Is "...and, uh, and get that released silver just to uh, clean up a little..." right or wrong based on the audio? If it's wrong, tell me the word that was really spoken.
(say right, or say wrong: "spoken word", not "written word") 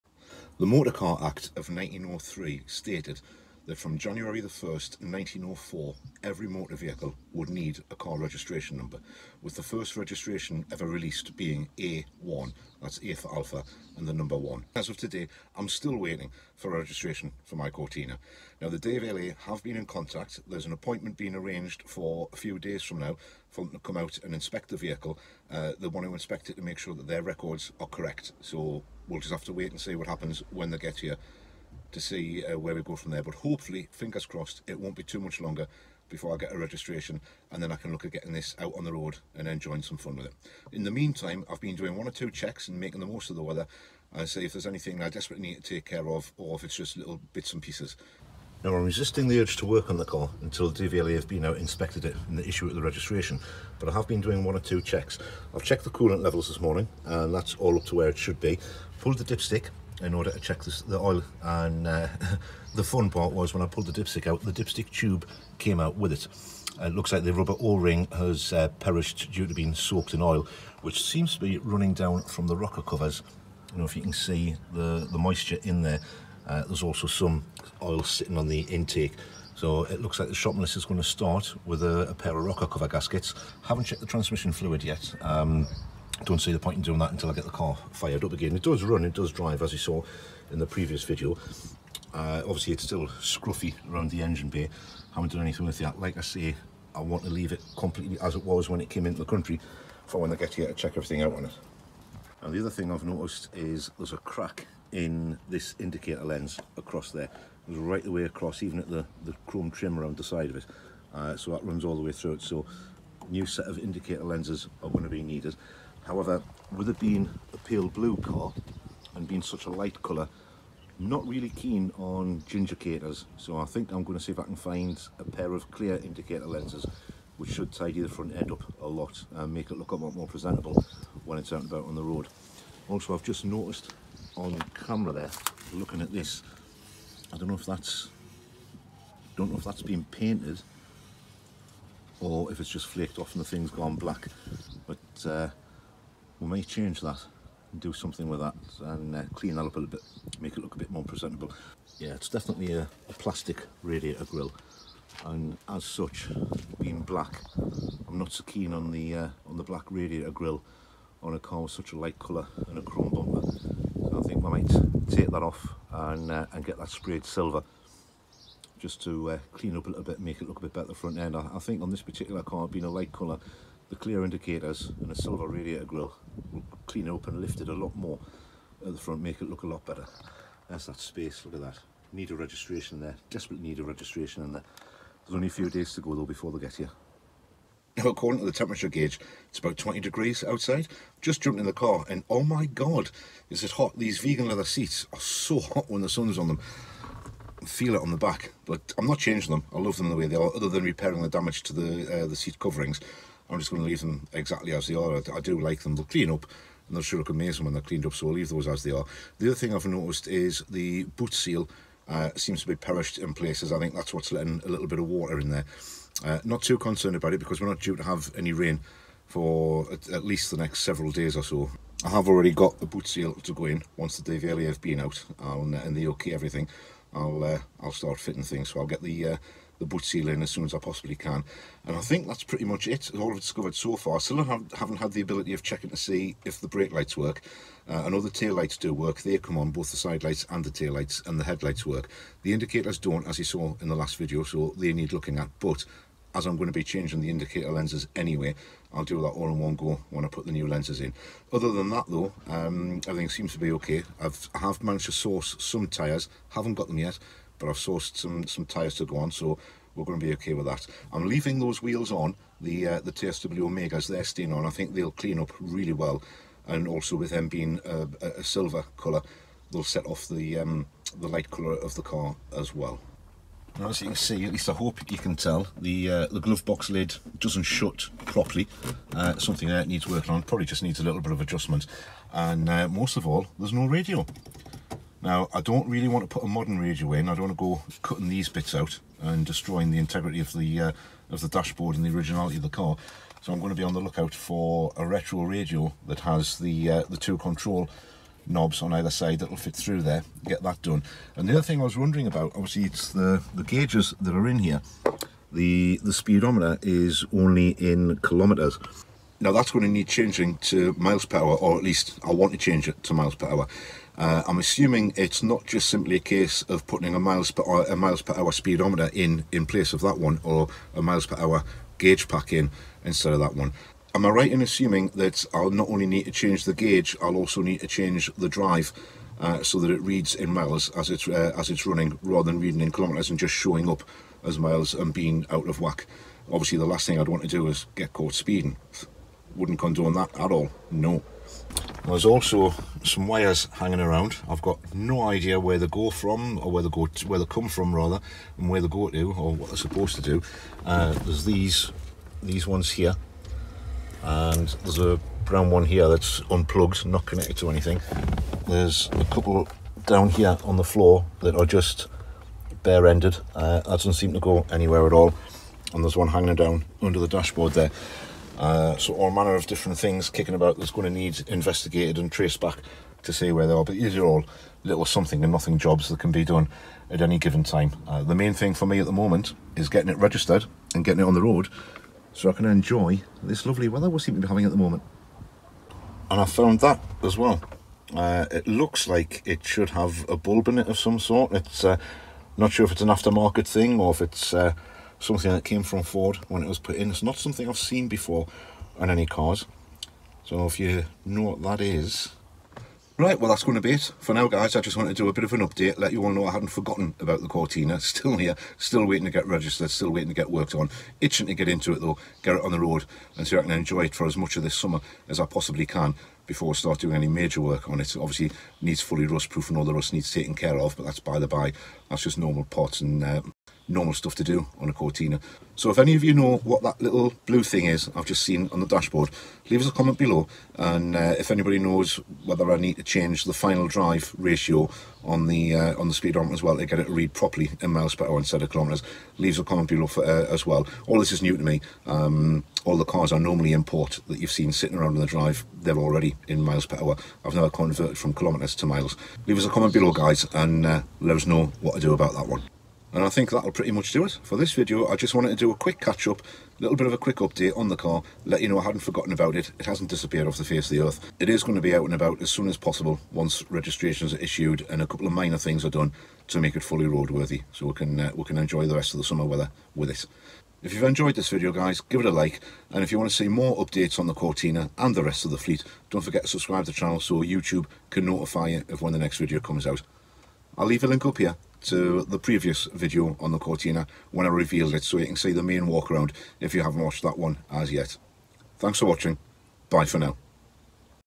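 wrong: "sprayed", not "released".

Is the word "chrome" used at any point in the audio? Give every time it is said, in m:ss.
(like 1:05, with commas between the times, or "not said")
1:49, 2:42.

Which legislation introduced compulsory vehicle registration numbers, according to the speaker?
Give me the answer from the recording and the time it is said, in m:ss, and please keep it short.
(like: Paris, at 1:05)
Motor Car Act of 1903, at 0:00.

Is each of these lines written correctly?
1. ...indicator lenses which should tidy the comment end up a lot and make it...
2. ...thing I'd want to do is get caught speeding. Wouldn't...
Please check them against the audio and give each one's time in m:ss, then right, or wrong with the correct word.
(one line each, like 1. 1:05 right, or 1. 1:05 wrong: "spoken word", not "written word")
1. 2:05 wrong: "front", not "comment"
2. 5:37 right.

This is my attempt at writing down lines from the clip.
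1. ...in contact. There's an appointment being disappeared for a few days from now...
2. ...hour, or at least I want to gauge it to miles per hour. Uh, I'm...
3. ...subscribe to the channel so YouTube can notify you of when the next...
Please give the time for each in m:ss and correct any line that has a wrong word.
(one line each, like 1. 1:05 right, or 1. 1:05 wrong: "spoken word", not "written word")
1. 0:19 wrong: "arranged", not "disappeared"
2. 5:11 wrong: "change", not "gauge"
3. 7:56 right.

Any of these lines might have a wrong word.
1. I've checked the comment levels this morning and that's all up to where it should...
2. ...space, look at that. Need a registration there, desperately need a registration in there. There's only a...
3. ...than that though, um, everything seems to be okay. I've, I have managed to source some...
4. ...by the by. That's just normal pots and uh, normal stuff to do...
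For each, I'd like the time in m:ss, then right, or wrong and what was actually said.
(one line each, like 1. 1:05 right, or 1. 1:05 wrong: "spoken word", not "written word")
1. 0:55 wrong: "coolant", not "comment"
2. 3:00 right
3. 4:11 right
4. 7:01 right.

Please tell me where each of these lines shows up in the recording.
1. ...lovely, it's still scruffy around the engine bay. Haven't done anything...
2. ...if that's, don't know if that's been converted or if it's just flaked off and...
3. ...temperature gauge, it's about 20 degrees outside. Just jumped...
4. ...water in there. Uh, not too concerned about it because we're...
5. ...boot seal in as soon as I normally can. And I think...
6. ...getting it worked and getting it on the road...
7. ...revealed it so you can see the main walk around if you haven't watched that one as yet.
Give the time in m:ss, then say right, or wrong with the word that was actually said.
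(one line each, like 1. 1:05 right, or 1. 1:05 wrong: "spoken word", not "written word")
1. 1:32 wrong: "obviously", not "lovely"
2. 2:17 wrong: "painted", not "converted"
3. 3:08 right
4. 3:35 right
5. 3:49 wrong: "possibly", not "normally"
6. 6:19 wrong: "registered", not "worked"
7. 8:04 right.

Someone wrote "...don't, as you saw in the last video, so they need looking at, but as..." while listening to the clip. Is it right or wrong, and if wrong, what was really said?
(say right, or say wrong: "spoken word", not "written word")
right.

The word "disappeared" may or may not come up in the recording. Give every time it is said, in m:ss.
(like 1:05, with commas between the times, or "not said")
7:40.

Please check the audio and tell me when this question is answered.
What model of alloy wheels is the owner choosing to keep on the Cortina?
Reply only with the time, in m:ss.
4:23.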